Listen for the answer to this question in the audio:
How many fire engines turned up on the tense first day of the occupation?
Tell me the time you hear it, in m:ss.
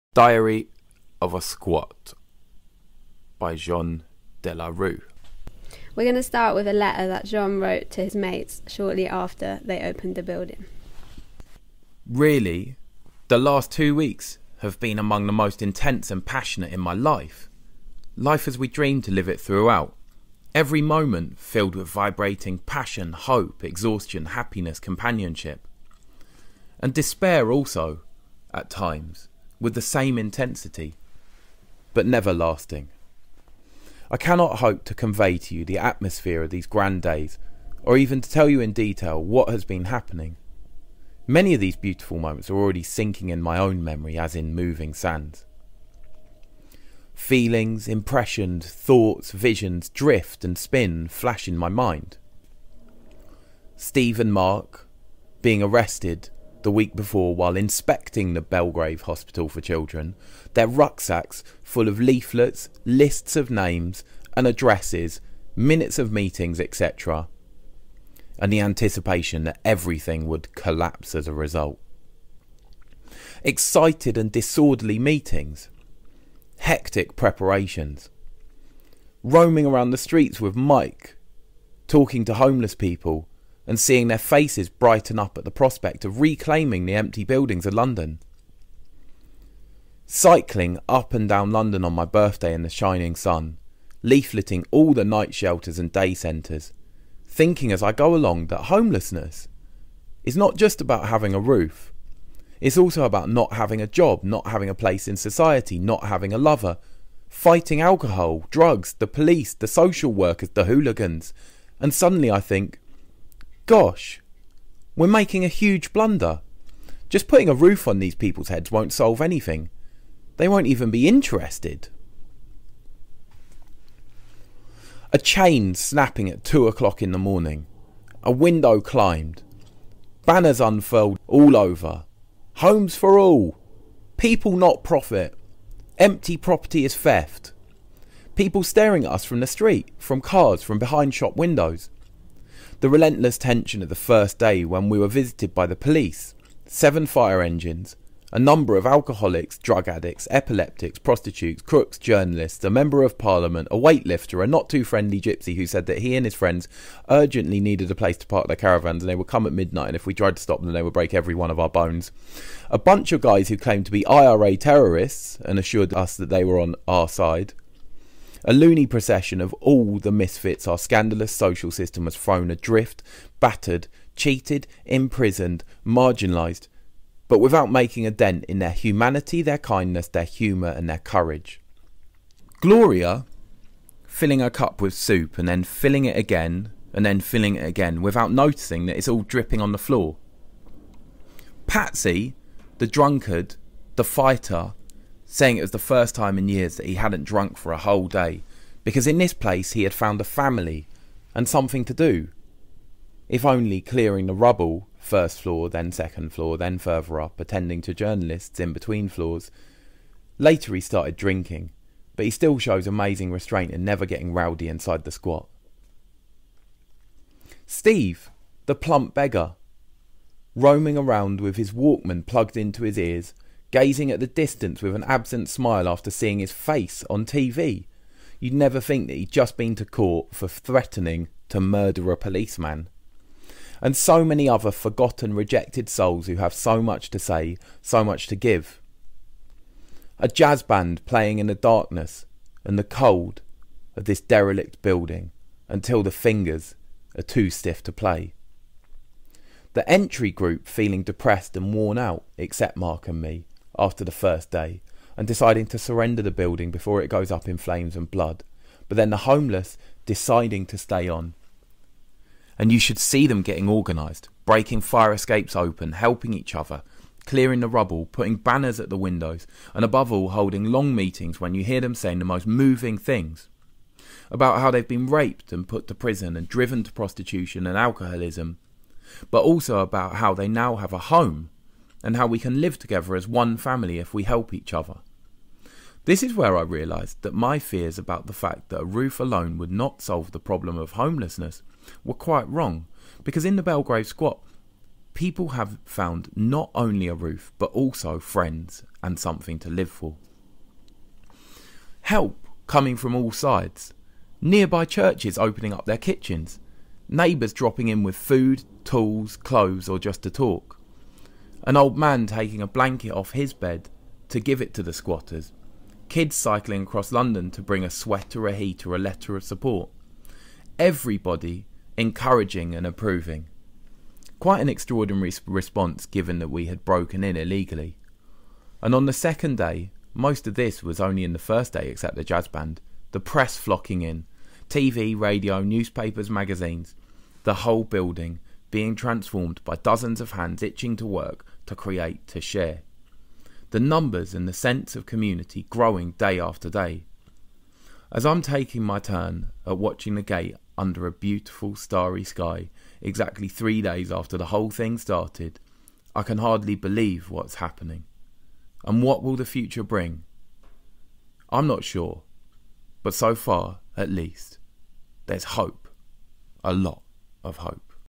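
2:26.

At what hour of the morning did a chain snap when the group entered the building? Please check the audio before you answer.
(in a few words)
2.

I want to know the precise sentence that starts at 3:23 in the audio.
If only clearing the rubble, first floor, then second floor, then further up, attending to journalists in between floors.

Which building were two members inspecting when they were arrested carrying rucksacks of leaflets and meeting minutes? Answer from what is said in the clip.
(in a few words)
Belgrave Hospital for Children.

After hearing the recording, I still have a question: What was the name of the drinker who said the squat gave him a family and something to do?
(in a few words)
Patsy.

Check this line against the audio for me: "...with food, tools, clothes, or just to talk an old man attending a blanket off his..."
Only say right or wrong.
wrong.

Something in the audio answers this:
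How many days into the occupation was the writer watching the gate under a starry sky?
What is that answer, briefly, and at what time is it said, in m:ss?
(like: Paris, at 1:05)
3, at 5:53.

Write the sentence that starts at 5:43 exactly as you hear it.
The numbers and the sense of community growing day after day.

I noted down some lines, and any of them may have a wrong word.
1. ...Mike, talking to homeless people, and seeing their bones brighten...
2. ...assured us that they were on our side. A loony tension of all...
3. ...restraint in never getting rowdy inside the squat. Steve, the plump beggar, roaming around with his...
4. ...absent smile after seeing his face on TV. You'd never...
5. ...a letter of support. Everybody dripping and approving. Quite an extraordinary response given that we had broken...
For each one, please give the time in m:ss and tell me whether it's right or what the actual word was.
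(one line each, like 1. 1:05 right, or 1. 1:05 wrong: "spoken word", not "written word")
1. 1:20 wrong: "faces", not "bones"
2. 2:45 wrong: "procession", not "tension"
3. 3:33 right
4. 3:45 right
5. 5:18 wrong: "encouraging", not "dripping".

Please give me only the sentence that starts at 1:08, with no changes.
And the anticipation that everything would collapse as a result.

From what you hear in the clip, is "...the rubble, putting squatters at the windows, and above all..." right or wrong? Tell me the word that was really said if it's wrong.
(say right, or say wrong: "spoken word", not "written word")
wrong: "banners", not "squatters".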